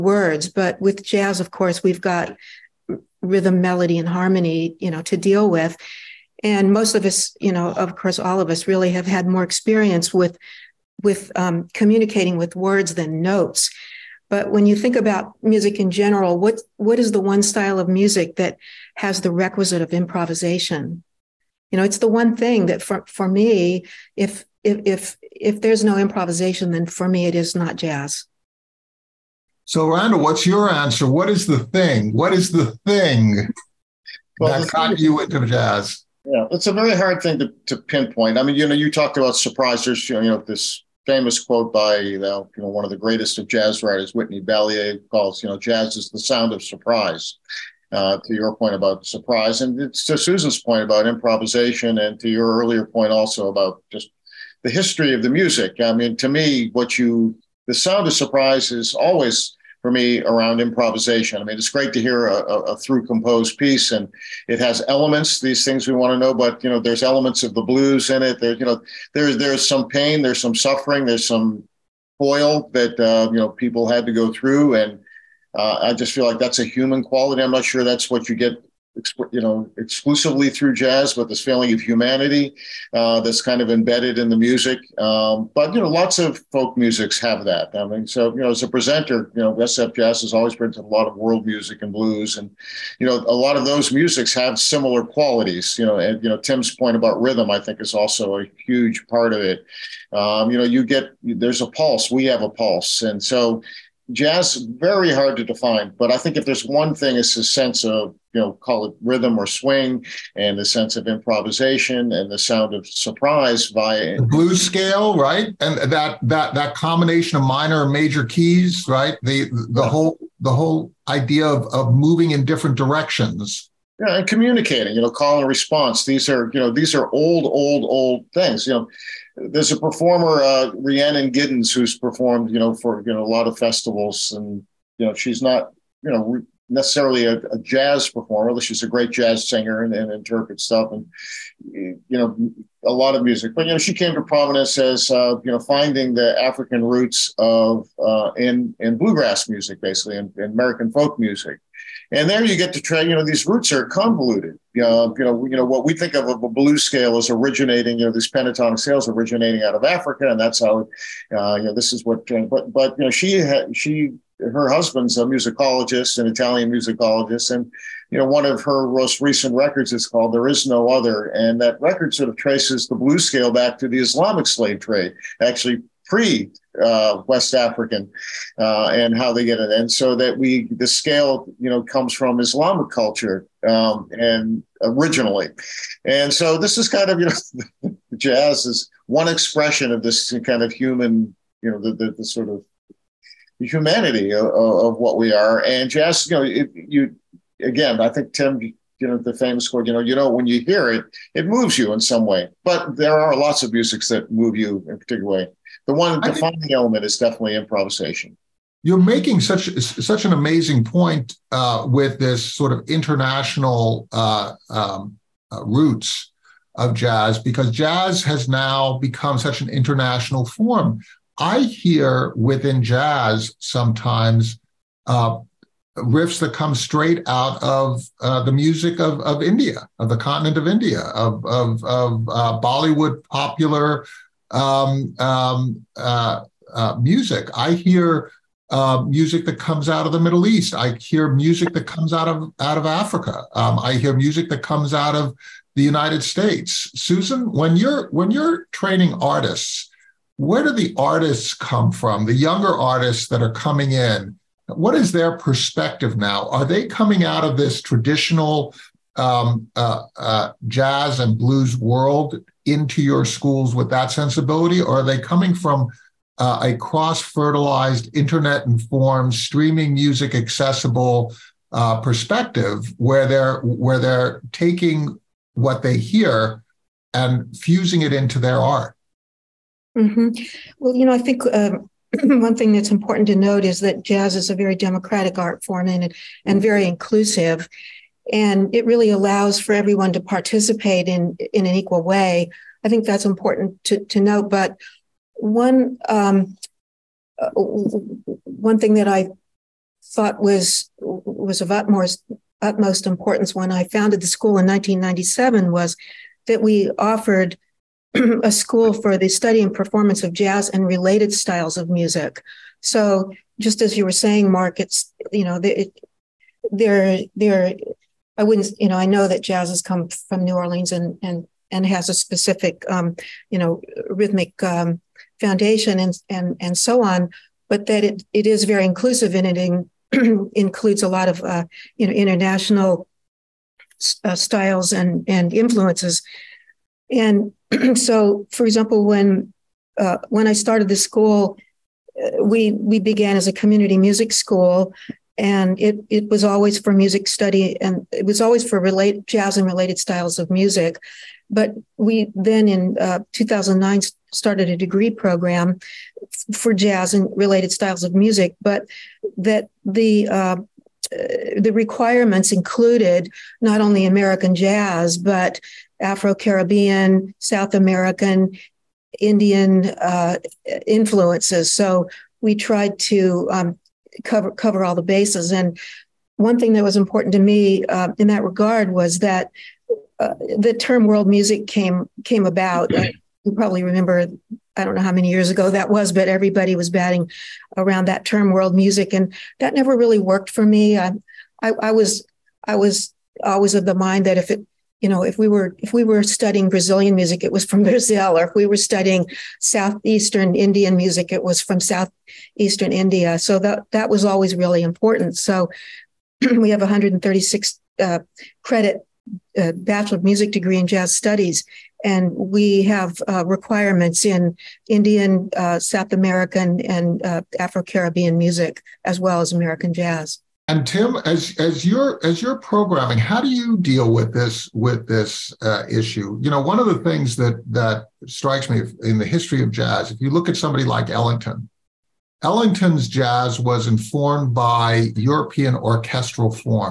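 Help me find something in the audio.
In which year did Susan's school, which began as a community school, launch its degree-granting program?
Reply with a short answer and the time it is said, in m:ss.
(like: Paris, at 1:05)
2009, at 5:53.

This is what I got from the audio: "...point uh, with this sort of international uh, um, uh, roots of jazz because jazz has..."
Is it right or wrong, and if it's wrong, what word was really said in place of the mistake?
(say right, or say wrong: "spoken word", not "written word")
right.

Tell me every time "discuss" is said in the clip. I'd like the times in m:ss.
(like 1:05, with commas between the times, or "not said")
not said.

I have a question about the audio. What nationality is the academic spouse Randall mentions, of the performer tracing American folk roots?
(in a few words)
Italian.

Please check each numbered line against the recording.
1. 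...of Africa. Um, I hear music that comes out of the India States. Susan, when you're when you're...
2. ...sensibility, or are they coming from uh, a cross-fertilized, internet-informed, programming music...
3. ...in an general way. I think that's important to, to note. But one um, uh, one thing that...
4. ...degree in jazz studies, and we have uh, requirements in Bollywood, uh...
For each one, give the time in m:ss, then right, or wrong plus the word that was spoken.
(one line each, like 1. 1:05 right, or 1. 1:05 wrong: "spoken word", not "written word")
1. 4:02 wrong: "United", not "India"
2. 4:24 wrong: "streaming", not "programming"
3. 4:51 wrong: "equal", not "general"
4. 6:50 wrong: "Indian", not "Bollywood".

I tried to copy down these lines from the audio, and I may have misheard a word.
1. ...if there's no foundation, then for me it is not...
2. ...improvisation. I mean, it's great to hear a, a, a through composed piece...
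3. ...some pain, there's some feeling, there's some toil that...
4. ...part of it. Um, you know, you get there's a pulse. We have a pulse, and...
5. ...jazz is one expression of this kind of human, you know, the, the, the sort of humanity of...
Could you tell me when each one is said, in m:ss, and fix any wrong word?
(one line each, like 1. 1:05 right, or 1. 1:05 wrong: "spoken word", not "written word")
1. 0:25 wrong: "improvisation", not "foundation"
2. 1:00 right
3. 1:09 wrong: "suffering", not "feeling"
4. 1:39 right
5. 3:08 right.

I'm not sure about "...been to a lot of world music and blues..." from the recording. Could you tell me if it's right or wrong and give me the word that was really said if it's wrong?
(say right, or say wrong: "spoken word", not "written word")
right.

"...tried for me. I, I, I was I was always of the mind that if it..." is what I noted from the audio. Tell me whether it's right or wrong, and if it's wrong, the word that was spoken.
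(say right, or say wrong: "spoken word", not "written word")
wrong: "worked", not "tried".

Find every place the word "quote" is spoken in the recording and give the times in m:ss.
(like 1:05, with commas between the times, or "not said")
0:41, 3:19.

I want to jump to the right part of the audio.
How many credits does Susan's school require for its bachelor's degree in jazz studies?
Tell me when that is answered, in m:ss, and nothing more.
6:46.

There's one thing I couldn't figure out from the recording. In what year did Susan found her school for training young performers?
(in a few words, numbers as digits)
1997.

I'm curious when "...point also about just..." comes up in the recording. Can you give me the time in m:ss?
0:52.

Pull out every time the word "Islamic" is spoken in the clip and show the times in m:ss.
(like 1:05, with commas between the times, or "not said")
2:53, 3:02.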